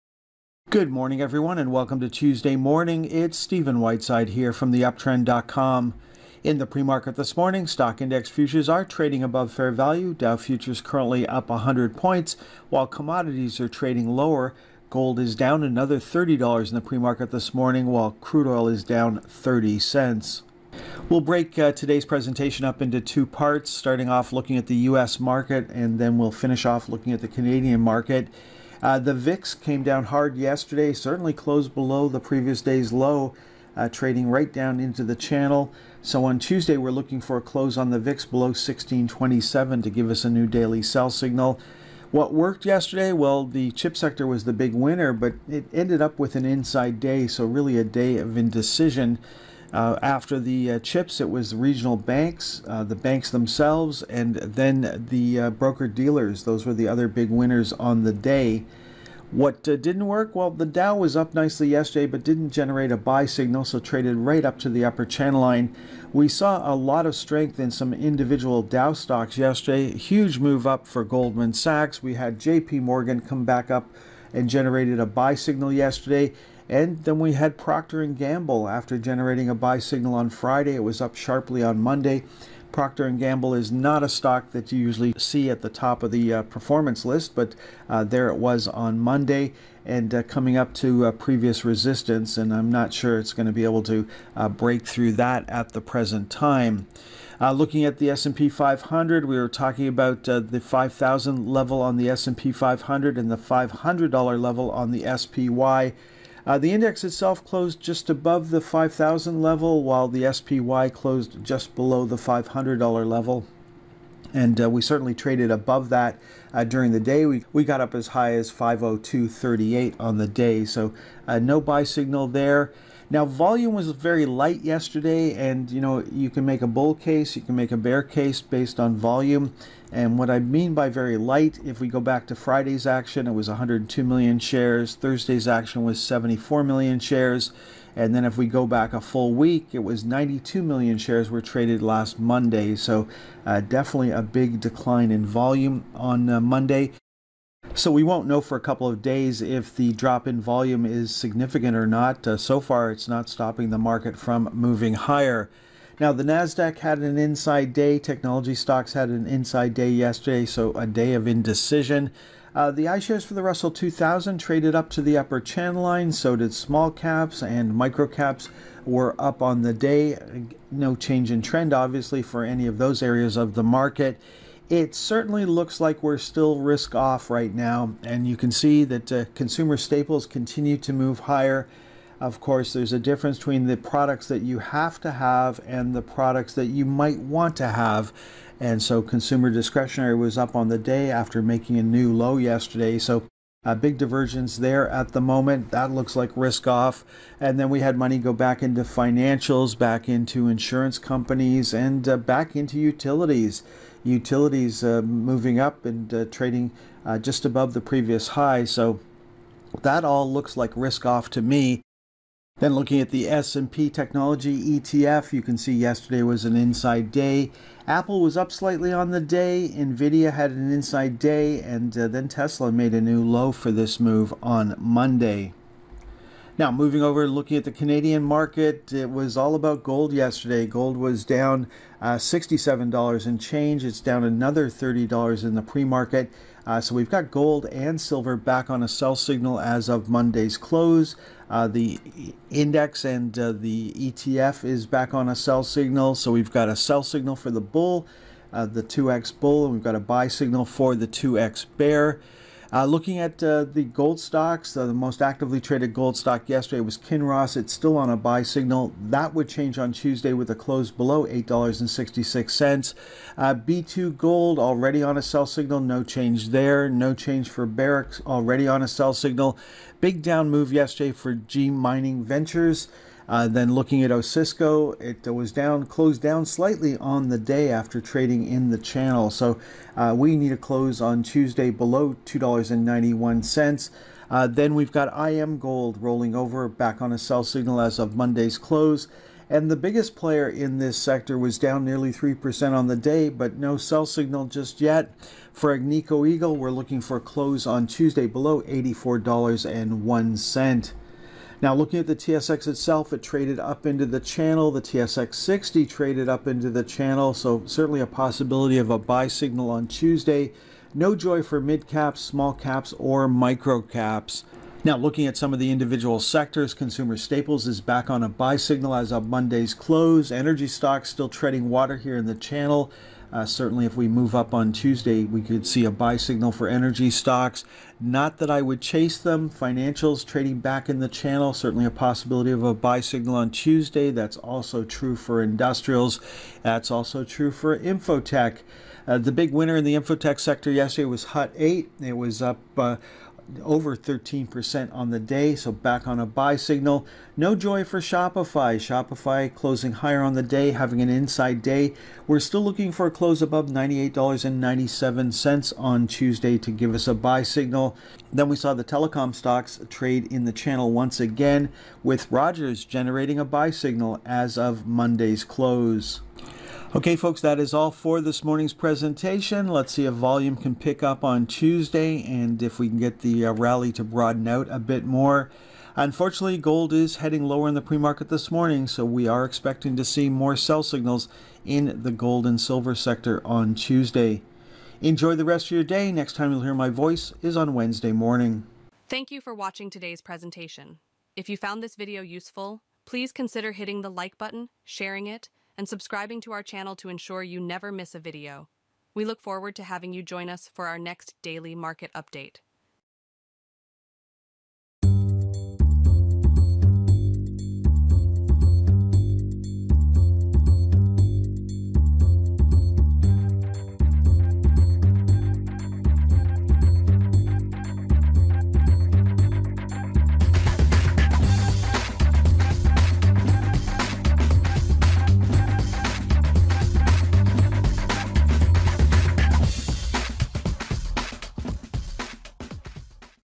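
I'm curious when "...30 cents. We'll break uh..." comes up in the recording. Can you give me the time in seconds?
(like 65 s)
19 s.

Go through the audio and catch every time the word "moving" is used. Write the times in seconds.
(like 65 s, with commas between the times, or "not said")
154 s, 205 s, 226 s.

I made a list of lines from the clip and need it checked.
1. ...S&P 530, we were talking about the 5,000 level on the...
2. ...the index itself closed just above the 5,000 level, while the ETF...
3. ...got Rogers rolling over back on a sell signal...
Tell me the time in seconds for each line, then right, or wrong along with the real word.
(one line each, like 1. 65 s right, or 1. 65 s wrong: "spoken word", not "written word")
1. 98 s wrong: "500", not "530"
2. 106 s wrong: "SPY", not "ETF"
3. 284 s wrong: "Iamgold", not "Rogers".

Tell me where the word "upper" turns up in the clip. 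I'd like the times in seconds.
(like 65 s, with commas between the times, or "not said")
64 s, 165 s.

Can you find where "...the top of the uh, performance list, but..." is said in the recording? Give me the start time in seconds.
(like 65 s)
85 s.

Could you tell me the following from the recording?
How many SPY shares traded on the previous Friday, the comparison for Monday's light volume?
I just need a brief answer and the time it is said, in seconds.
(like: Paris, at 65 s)
102 million, at 133 s.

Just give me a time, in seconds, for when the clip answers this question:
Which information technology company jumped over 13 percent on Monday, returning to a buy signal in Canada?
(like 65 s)
341 s.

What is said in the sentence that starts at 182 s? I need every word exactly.
Of course, there's a difference between the products that you have to have and the products that you might want to have.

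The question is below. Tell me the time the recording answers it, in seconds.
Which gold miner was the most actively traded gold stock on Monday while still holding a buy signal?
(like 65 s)
256 s.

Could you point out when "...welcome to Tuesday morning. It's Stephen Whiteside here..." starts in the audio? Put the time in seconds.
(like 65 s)
1 s.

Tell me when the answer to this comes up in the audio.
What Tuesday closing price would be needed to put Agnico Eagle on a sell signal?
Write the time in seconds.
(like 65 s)
298 s.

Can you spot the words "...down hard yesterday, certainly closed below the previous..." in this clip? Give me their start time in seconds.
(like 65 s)
29 s.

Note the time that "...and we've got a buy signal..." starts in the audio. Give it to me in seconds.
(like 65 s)
249 s.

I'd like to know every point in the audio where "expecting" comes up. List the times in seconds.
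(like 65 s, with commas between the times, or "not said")
379 s.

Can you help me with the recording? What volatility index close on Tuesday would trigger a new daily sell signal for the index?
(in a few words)
1627.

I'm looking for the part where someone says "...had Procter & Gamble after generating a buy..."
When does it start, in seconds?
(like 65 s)
77 s.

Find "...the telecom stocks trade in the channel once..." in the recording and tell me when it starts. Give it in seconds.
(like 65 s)
358 s.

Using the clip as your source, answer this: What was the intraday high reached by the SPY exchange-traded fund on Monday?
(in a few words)
502.38.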